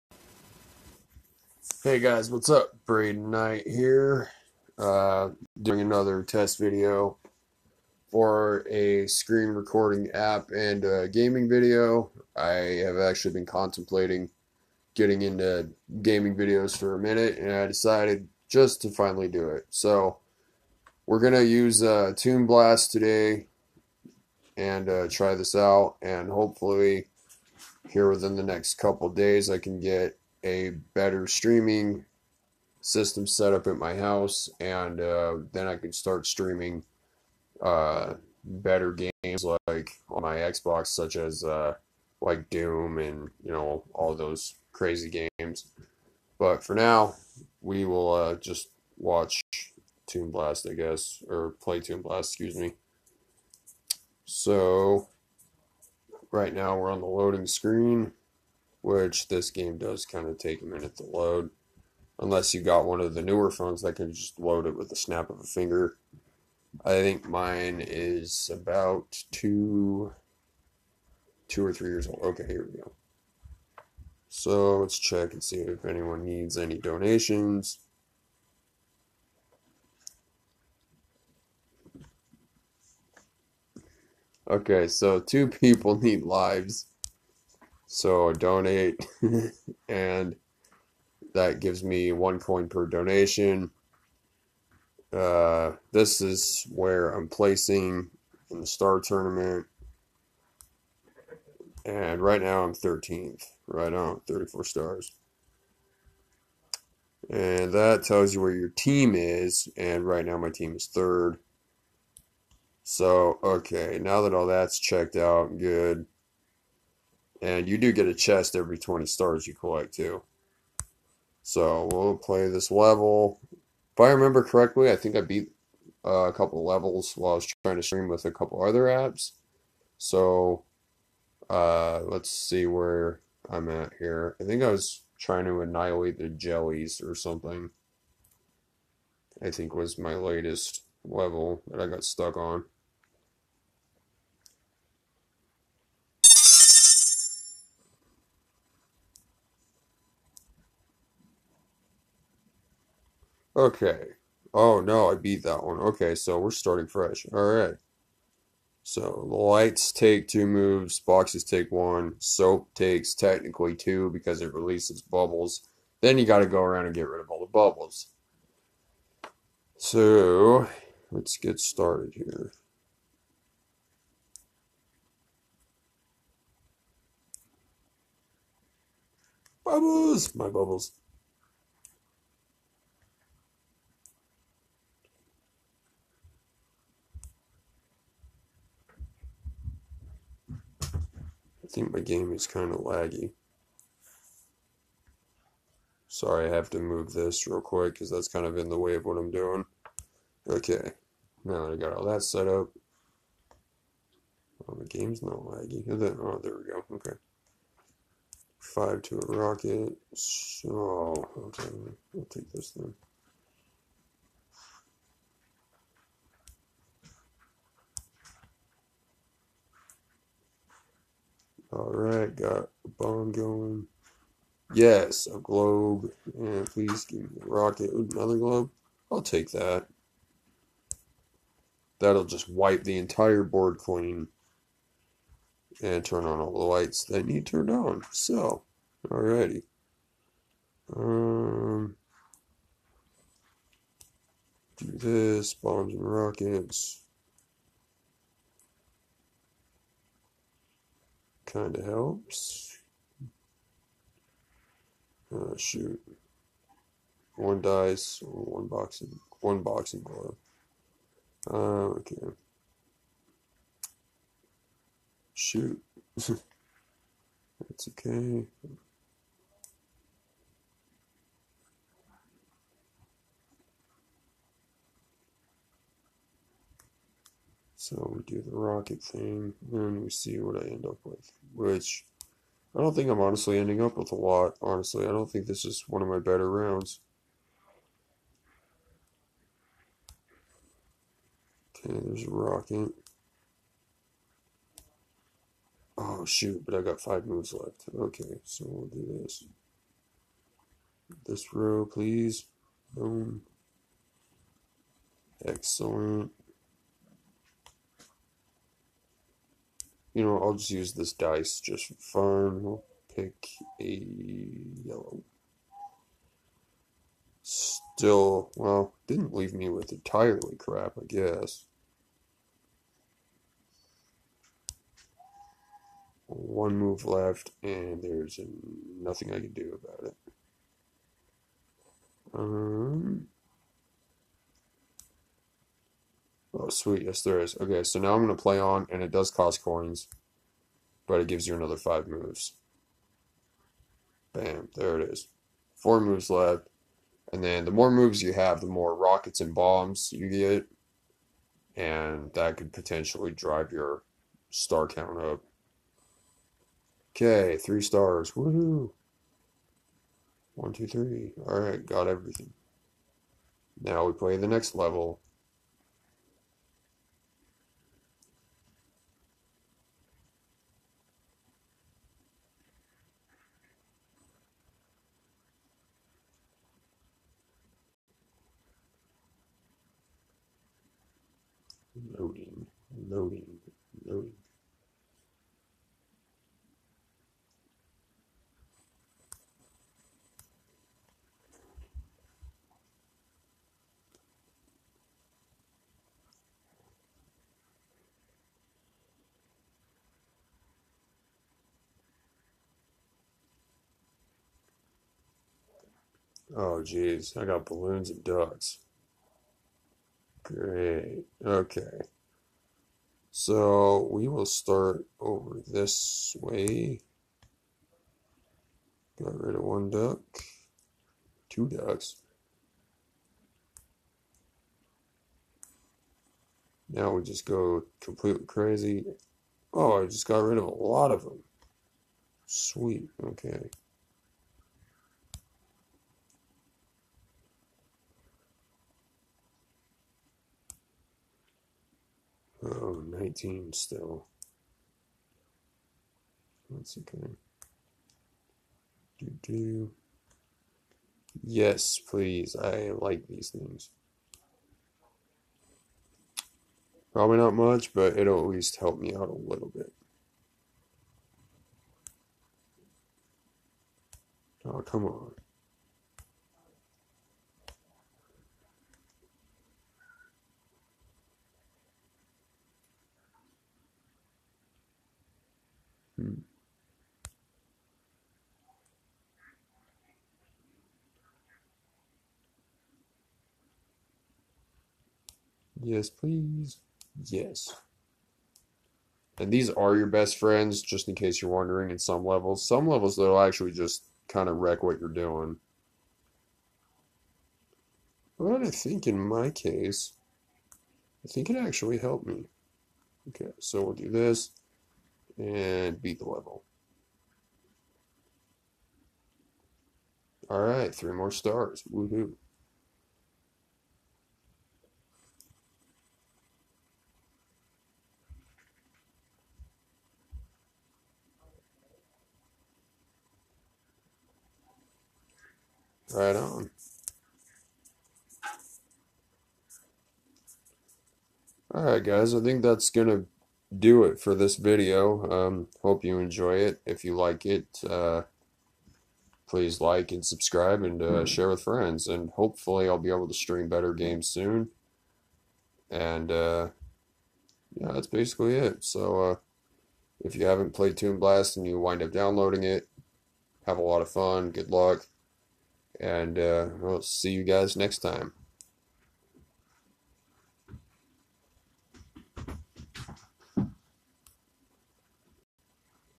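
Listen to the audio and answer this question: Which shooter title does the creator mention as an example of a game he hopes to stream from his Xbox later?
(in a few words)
Doom.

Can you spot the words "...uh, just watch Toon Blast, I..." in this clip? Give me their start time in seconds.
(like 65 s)
48 s.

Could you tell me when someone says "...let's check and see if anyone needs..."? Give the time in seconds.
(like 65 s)
74 s.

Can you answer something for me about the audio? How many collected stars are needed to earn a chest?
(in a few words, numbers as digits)
20.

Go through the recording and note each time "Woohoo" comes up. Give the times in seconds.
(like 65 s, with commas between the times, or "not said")
358 s, 511 s.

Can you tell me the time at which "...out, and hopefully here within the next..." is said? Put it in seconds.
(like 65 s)
25 s.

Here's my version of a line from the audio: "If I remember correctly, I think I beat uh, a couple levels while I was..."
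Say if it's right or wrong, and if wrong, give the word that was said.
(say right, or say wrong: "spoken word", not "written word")
right.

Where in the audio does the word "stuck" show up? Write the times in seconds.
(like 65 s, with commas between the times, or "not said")
142 s.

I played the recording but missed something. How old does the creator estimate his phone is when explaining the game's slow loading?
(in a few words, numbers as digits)
2 or 3 years.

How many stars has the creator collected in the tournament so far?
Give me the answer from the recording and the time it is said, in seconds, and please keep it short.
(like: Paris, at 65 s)
34, at 104 s.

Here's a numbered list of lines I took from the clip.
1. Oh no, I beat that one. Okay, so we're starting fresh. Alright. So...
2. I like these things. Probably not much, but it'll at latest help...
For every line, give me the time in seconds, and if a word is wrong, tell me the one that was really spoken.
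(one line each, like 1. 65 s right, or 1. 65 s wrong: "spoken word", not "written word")
1. 154 s right
2. 452 s wrong: "least", not "latest".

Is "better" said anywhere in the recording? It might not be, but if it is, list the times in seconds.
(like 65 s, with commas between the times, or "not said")
30 s, 38 s, 286 s, 543 s.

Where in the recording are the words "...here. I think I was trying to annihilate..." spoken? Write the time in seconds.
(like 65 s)
133 s.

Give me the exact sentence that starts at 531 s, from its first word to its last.
All right, guys, I think that's going to do it for this video.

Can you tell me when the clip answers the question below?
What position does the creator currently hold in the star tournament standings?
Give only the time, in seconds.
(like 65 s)
102 s.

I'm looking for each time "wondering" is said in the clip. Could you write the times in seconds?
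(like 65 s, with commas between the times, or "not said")
491 s.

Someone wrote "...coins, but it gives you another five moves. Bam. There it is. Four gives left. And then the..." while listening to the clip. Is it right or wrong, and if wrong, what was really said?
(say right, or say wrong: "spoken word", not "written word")
wrong: "moves", not "gives".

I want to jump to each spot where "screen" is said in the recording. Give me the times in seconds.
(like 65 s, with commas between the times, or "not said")
9 s, 57 s.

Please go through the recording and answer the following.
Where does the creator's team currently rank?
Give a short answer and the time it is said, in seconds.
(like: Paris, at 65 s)
third, at 110 s.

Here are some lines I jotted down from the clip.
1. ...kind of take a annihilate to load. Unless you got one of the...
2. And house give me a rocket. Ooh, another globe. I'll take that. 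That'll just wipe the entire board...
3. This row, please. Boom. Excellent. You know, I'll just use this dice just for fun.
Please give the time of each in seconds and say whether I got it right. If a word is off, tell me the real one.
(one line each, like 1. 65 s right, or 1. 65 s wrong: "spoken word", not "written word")
1. 60 s wrong: "minute", not "annihilate"
2. 226 s wrong: "please", not "house"
3. 301 s right.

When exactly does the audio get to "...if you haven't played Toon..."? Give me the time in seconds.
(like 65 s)
550 s.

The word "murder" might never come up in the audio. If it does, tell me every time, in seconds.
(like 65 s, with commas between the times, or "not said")
not said.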